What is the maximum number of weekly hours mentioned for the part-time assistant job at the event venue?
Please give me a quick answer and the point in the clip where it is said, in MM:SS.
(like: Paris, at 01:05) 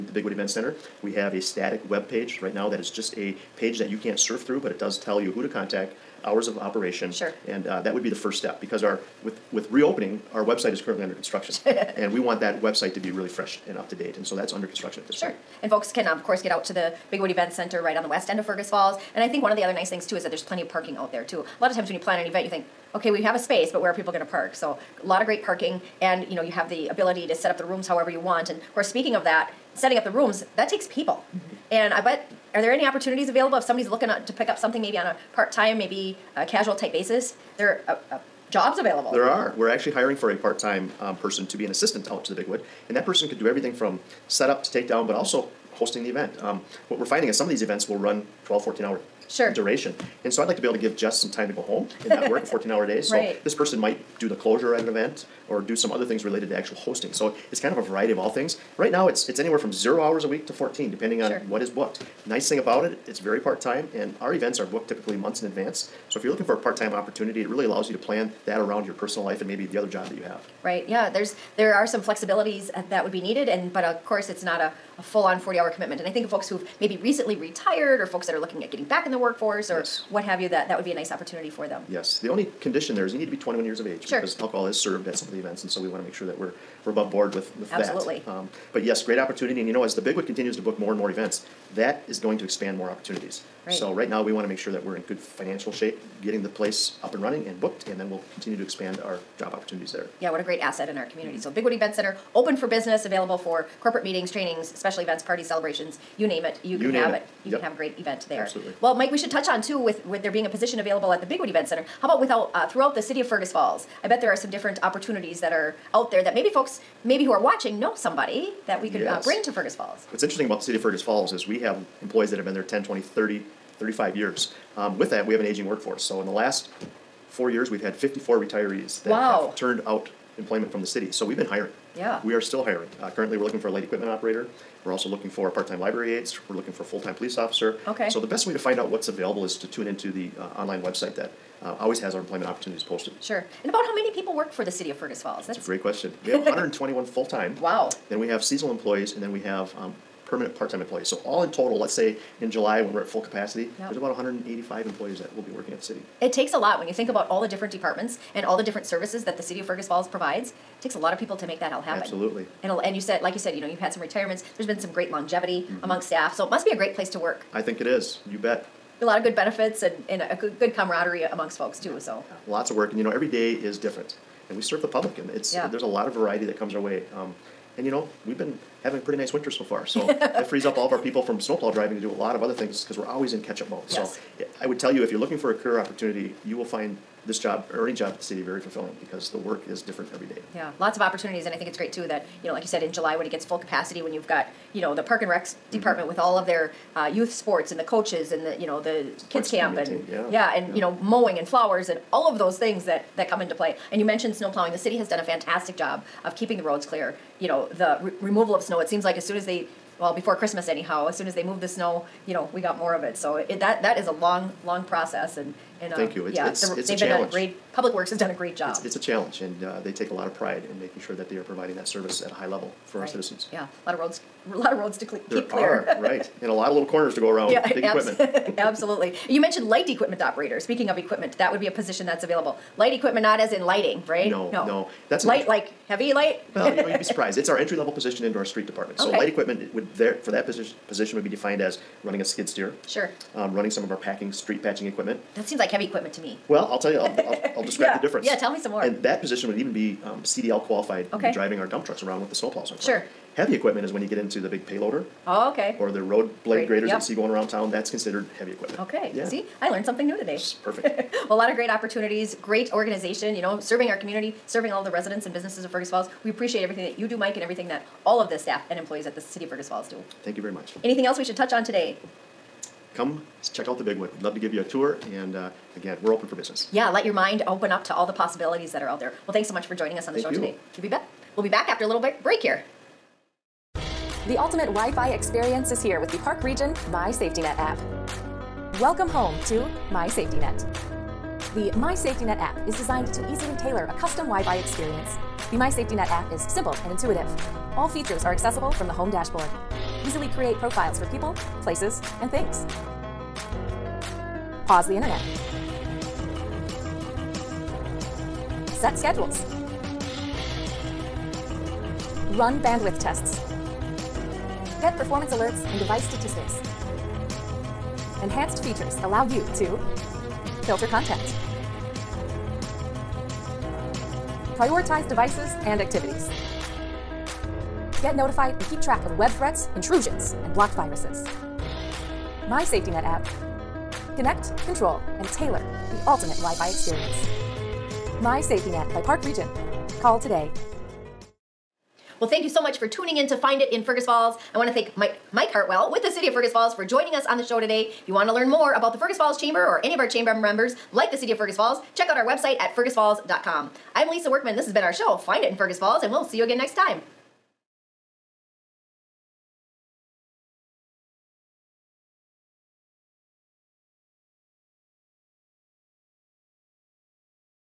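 14, at 01:00.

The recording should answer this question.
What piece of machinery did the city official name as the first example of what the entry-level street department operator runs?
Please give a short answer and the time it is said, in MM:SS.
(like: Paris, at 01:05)
skid steer, at 04:02.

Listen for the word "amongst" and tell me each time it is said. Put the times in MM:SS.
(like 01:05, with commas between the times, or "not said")
02:45, 02:51.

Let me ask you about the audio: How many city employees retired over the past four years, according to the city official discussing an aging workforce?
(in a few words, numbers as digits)
54.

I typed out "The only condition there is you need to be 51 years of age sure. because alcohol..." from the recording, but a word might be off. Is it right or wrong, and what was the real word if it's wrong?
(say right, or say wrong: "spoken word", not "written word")
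wrong: "21", not "51".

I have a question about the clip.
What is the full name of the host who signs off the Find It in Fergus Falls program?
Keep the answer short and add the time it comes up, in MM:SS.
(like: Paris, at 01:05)
Lisa Workman, at 05:54.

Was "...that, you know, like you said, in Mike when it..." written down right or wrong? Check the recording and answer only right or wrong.
wrong.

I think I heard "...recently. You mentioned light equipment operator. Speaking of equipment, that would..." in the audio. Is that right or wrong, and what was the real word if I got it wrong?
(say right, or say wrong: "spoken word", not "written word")
wrong: "absolutely", not "recently".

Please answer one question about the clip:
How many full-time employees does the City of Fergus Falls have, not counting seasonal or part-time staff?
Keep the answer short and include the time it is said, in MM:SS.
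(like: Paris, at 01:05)
121, at 02:26.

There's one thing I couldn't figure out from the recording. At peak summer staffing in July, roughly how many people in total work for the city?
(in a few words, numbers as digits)
185.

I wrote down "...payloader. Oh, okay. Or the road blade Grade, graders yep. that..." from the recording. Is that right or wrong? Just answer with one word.
right.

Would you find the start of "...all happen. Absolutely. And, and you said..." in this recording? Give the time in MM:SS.
02:41.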